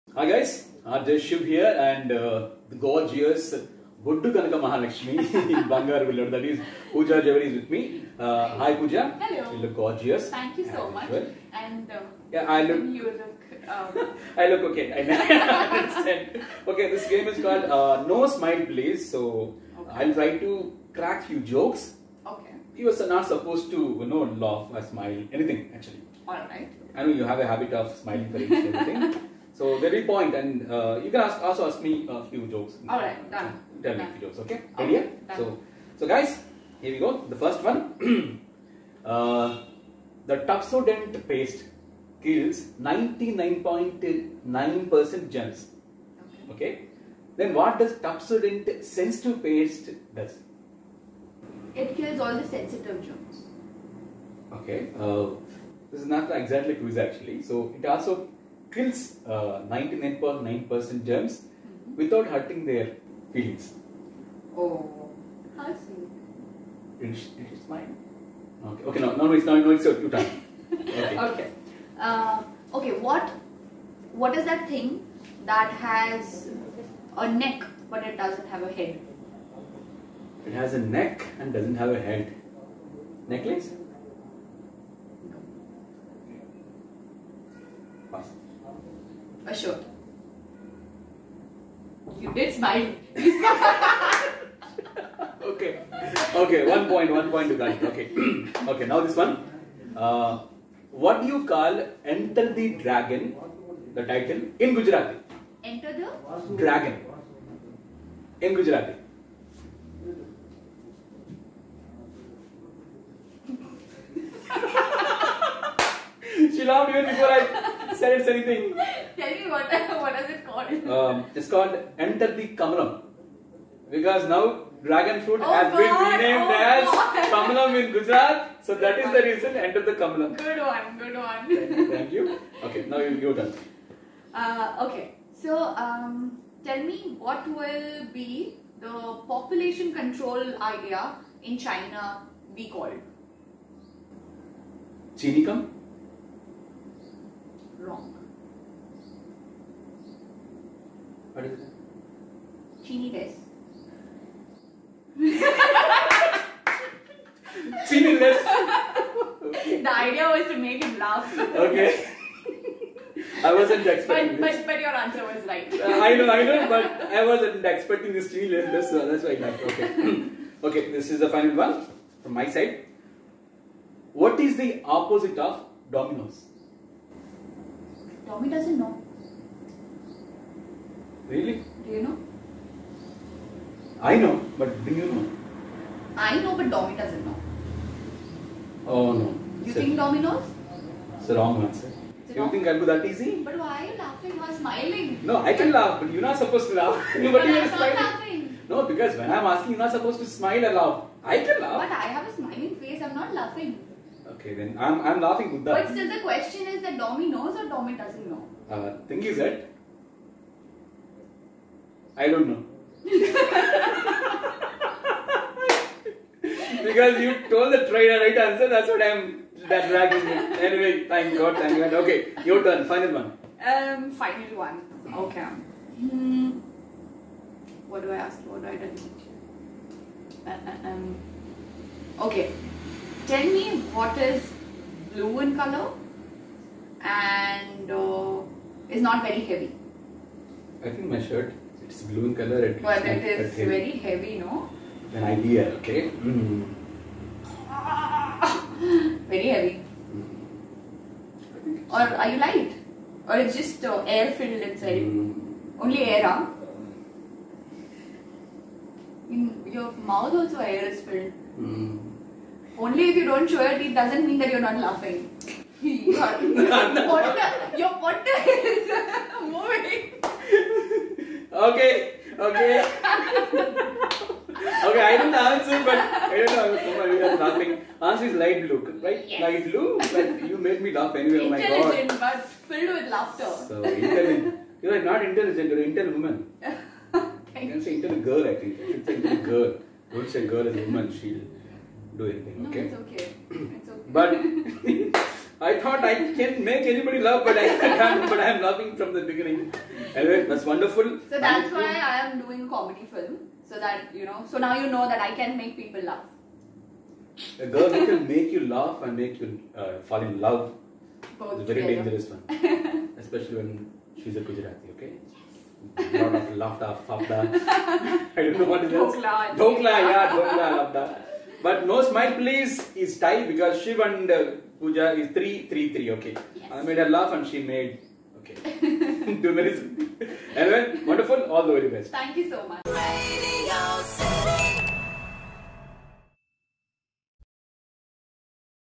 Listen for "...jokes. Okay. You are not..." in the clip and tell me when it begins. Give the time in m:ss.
0:21.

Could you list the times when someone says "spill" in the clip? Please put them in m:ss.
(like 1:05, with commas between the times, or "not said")
not said.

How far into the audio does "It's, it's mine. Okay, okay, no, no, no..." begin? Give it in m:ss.
1:07.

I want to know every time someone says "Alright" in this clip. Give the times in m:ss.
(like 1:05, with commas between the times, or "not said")
0:26.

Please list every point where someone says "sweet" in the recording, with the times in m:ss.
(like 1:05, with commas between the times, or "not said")
1:05.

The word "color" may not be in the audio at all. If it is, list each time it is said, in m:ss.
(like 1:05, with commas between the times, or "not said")
3:55, 4:02.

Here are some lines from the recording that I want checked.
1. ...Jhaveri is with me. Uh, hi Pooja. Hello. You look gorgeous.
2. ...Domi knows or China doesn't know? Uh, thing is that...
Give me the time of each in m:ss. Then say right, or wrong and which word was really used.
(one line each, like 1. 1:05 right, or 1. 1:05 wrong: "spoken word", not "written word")
1. 0:07 right
2. 3:26 wrong: "Domi", not "China".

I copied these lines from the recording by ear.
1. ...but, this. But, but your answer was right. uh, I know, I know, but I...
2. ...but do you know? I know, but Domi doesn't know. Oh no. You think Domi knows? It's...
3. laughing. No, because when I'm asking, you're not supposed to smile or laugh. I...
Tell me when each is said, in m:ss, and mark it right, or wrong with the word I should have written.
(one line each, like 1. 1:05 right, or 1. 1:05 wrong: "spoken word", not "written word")
1. 2:44 right
2. 3:04 right
3. 3:18 right.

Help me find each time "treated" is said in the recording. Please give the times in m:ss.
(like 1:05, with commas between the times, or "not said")
not said.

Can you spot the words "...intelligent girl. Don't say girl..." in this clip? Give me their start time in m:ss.
4:49.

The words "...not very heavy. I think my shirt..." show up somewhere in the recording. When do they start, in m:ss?
3:59.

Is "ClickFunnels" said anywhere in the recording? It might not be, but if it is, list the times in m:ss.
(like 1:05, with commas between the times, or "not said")
not said.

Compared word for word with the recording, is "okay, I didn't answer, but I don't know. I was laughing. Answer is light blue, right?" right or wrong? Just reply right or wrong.
right.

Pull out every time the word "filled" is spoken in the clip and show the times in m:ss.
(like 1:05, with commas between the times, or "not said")
4:14, 4:21, 4:42.